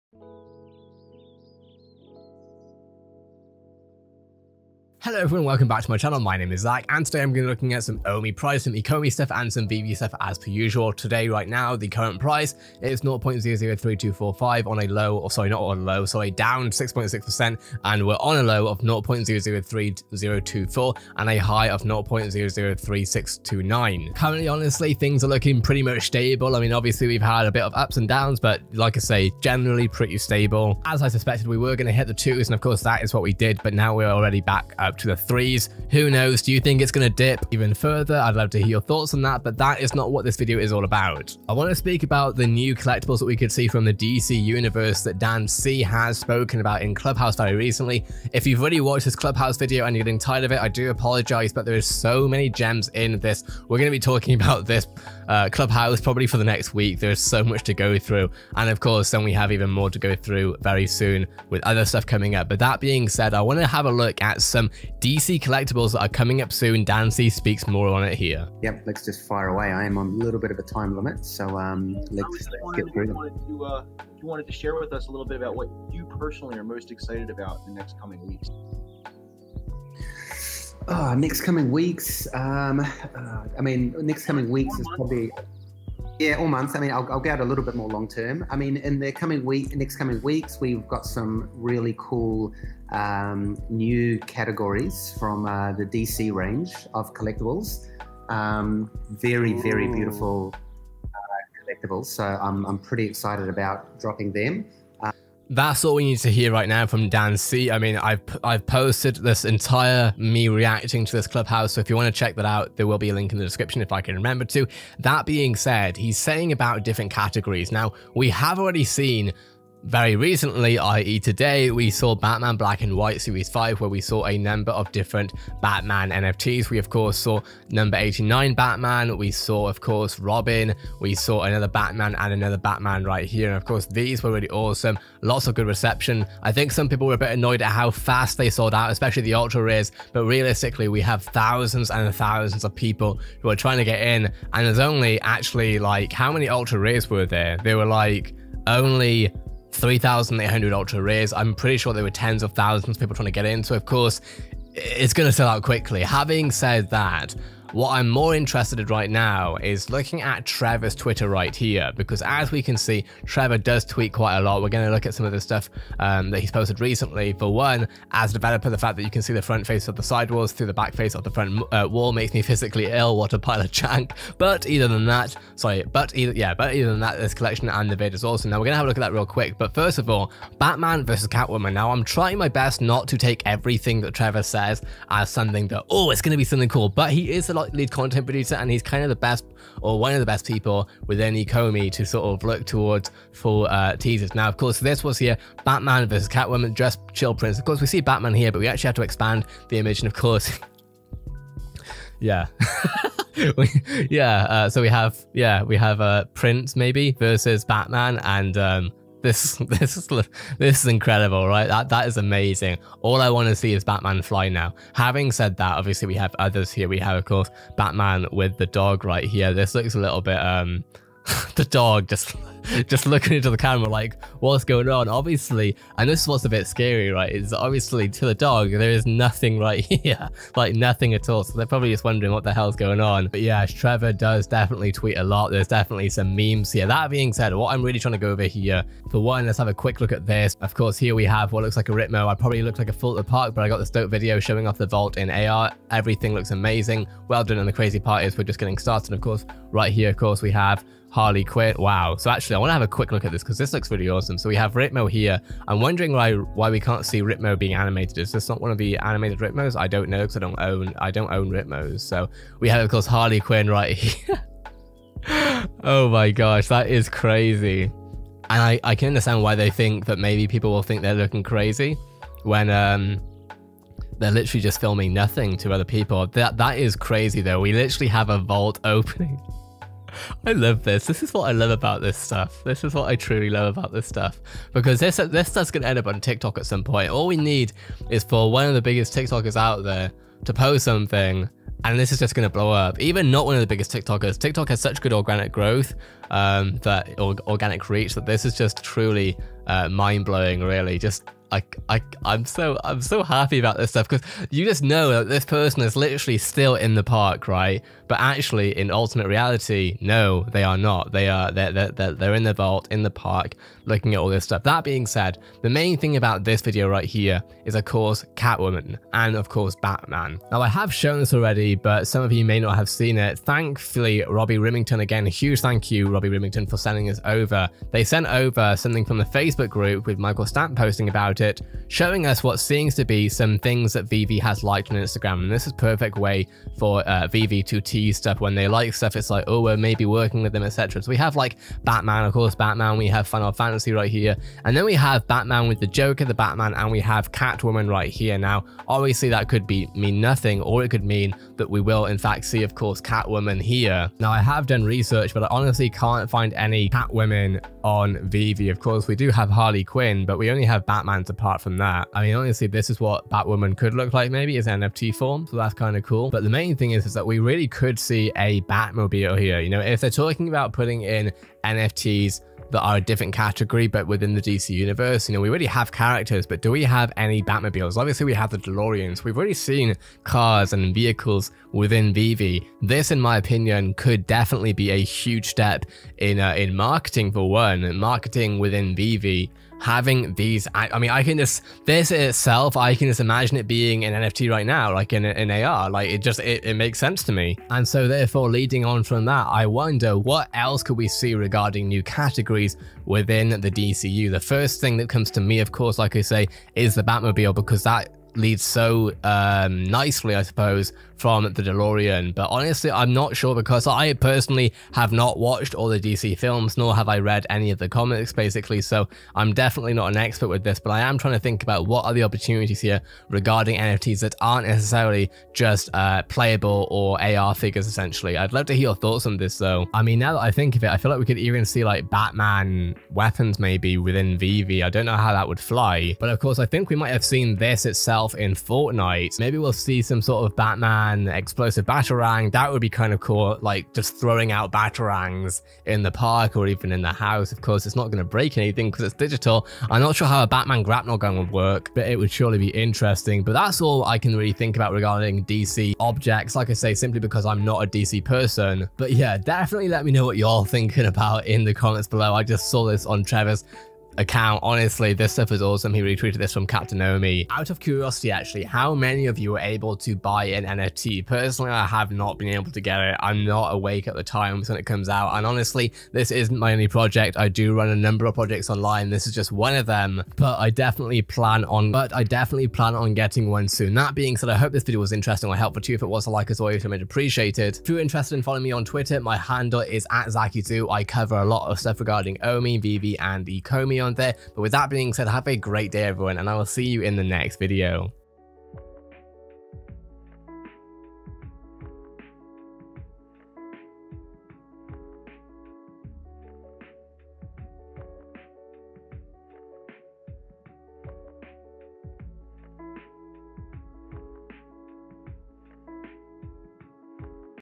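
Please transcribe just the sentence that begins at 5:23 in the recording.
Thankfully, Robbie Rimmington again, huge thank you, Robbie Rimmington, for sending this over.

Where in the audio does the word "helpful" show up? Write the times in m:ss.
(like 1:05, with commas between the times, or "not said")
8:05.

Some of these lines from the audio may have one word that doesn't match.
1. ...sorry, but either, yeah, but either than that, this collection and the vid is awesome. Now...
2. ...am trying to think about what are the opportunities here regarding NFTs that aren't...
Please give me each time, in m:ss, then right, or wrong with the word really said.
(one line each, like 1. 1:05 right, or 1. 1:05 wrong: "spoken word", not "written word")
1. 2:55 right
2. 7:01 right.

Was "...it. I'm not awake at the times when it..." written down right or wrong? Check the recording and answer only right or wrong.
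right.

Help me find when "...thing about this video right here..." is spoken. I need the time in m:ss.
5:15.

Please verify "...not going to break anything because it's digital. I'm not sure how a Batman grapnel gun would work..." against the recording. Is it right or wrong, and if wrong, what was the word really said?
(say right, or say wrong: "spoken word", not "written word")
right.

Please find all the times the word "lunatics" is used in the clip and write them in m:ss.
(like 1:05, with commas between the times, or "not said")
not said.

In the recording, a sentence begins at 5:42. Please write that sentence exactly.
We have Final Fantasy right here.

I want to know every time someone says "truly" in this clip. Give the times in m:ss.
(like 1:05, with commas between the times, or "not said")
4:43, 4:58.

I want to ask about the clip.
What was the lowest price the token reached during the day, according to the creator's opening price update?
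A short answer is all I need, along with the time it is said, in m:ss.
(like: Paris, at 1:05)
0.003024, at 0:18.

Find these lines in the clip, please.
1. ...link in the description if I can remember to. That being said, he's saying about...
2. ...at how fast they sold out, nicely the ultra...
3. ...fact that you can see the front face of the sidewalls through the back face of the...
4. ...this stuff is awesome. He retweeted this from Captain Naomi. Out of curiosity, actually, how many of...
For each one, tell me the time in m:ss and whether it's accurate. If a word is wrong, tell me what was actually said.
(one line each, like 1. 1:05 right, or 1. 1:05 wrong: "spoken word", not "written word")
1. 1:53 right
2. 2:17 wrong: "especially", not "nicely"
3. 2:48 right
4. 7:45 right.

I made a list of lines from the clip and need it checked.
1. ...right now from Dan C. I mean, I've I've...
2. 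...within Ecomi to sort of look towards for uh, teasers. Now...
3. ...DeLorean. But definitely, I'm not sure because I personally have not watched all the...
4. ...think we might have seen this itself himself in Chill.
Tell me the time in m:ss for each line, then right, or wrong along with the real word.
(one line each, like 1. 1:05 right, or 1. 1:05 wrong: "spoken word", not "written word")
1. 1:46 right
2. 3:11 right
3. 6:51 wrong: "honestly", not "definitely"
4. 7:16 wrong: "Fortnite", not "Chill".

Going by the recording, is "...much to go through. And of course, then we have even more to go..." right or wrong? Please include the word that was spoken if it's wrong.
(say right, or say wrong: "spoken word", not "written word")
right.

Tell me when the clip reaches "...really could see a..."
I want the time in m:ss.
6:07.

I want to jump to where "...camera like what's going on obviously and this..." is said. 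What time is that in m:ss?
3:43.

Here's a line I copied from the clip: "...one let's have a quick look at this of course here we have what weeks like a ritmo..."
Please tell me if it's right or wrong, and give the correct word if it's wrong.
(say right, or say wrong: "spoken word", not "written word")
wrong: "looks", not "weeks".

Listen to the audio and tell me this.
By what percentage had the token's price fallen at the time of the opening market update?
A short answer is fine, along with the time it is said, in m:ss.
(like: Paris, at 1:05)
6.6%, at 0:16.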